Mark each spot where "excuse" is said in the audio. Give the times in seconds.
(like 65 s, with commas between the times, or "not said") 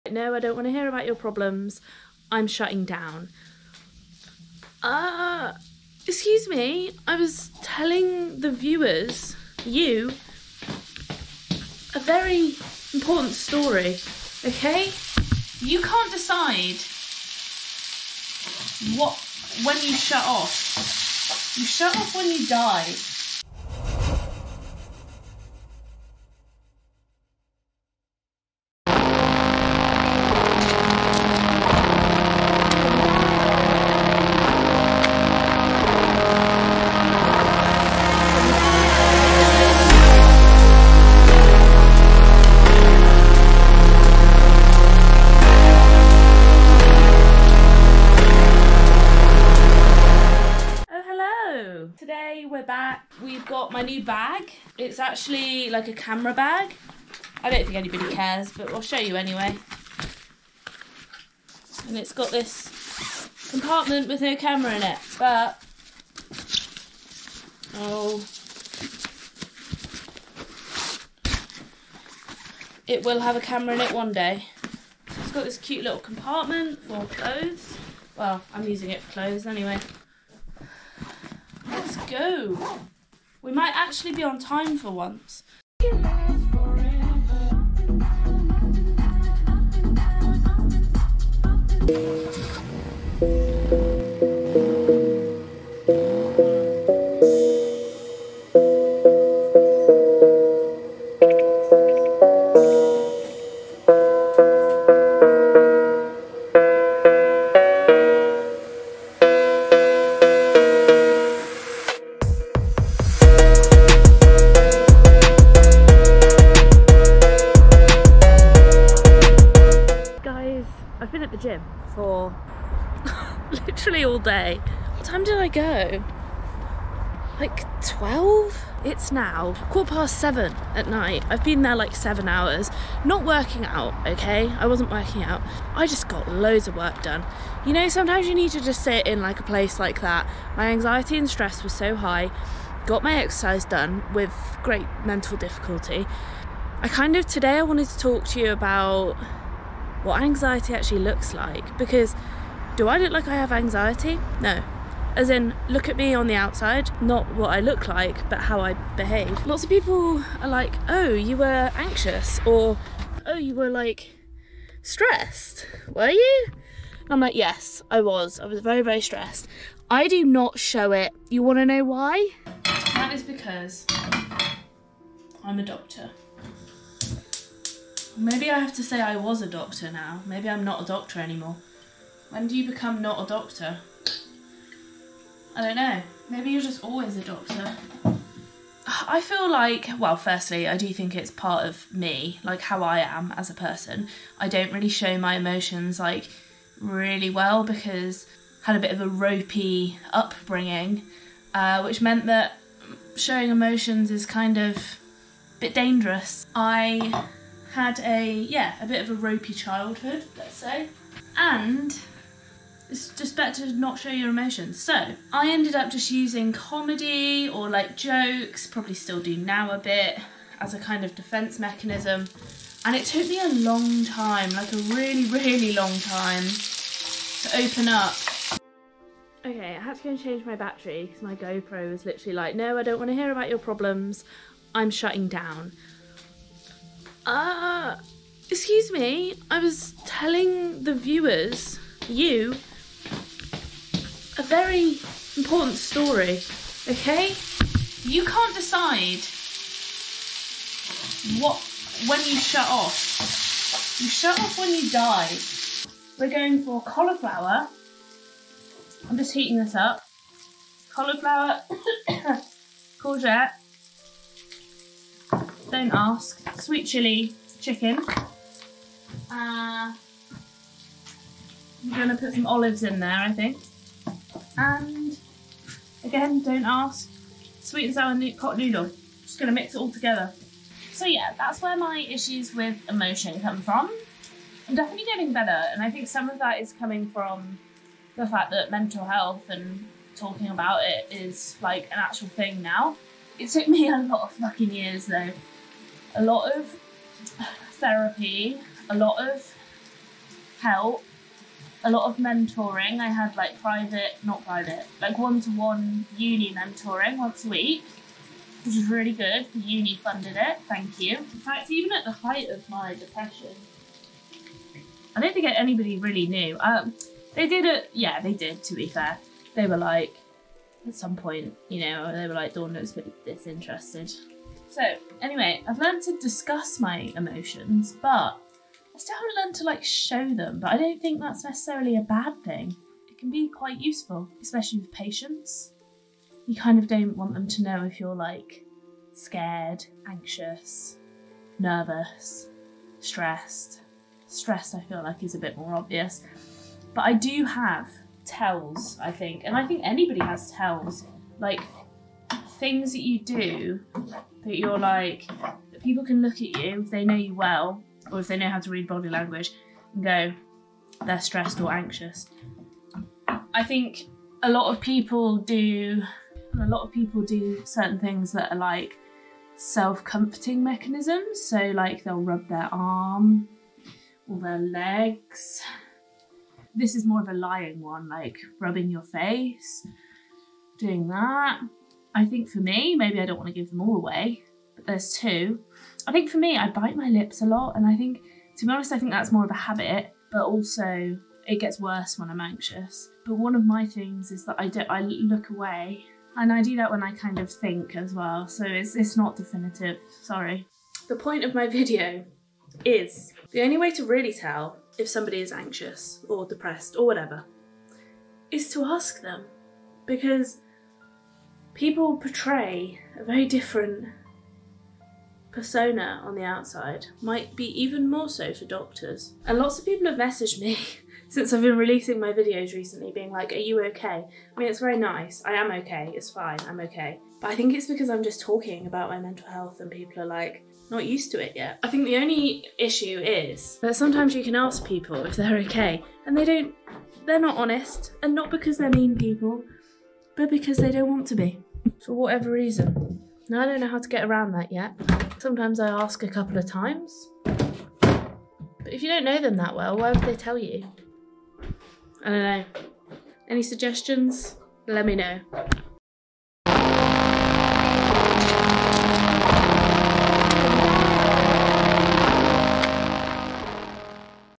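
6 s, 238 s.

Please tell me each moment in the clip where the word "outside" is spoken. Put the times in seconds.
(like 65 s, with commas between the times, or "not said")
156 s, 416 s.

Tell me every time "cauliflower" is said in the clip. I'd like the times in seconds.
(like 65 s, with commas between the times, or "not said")
256 s, 260 s.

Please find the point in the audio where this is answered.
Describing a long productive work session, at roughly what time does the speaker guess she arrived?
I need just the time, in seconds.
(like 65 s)
127 s.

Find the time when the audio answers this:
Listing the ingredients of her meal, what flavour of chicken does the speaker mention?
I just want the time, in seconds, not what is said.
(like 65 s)
266 s.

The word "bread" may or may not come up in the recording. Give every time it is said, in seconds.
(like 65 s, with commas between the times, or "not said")
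not said.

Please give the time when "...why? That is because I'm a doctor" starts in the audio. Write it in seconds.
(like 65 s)
171 s.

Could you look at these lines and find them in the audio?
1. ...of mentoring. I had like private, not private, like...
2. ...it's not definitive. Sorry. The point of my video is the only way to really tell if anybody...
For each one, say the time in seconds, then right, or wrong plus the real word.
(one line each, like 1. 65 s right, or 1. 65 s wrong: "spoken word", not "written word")
1. 302 s right
2. 398 s wrong: "somebody", not "anybody".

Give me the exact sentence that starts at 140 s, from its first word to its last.
My anxiety and stress was so high.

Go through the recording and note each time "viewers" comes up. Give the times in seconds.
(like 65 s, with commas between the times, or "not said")
8 s, 240 s.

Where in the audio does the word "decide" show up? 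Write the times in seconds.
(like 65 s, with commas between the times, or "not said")
16 s, 248 s.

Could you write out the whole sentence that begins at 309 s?
The uni funded it, thank you.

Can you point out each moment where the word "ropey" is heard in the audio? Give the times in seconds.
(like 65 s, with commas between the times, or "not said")
199 s, 209 s.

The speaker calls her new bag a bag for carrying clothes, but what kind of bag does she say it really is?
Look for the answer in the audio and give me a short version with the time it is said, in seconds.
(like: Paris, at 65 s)
Camera bag, at 55 s.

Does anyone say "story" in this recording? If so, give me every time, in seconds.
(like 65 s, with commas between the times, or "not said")
13 s, 245 s.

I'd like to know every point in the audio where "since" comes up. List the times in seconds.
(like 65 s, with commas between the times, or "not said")
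421 s.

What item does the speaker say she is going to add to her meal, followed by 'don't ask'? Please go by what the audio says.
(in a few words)
Olives.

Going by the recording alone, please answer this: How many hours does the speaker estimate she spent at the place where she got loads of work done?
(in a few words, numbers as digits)
7.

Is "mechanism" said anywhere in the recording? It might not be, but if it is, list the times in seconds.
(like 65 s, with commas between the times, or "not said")
221 s, 370 s.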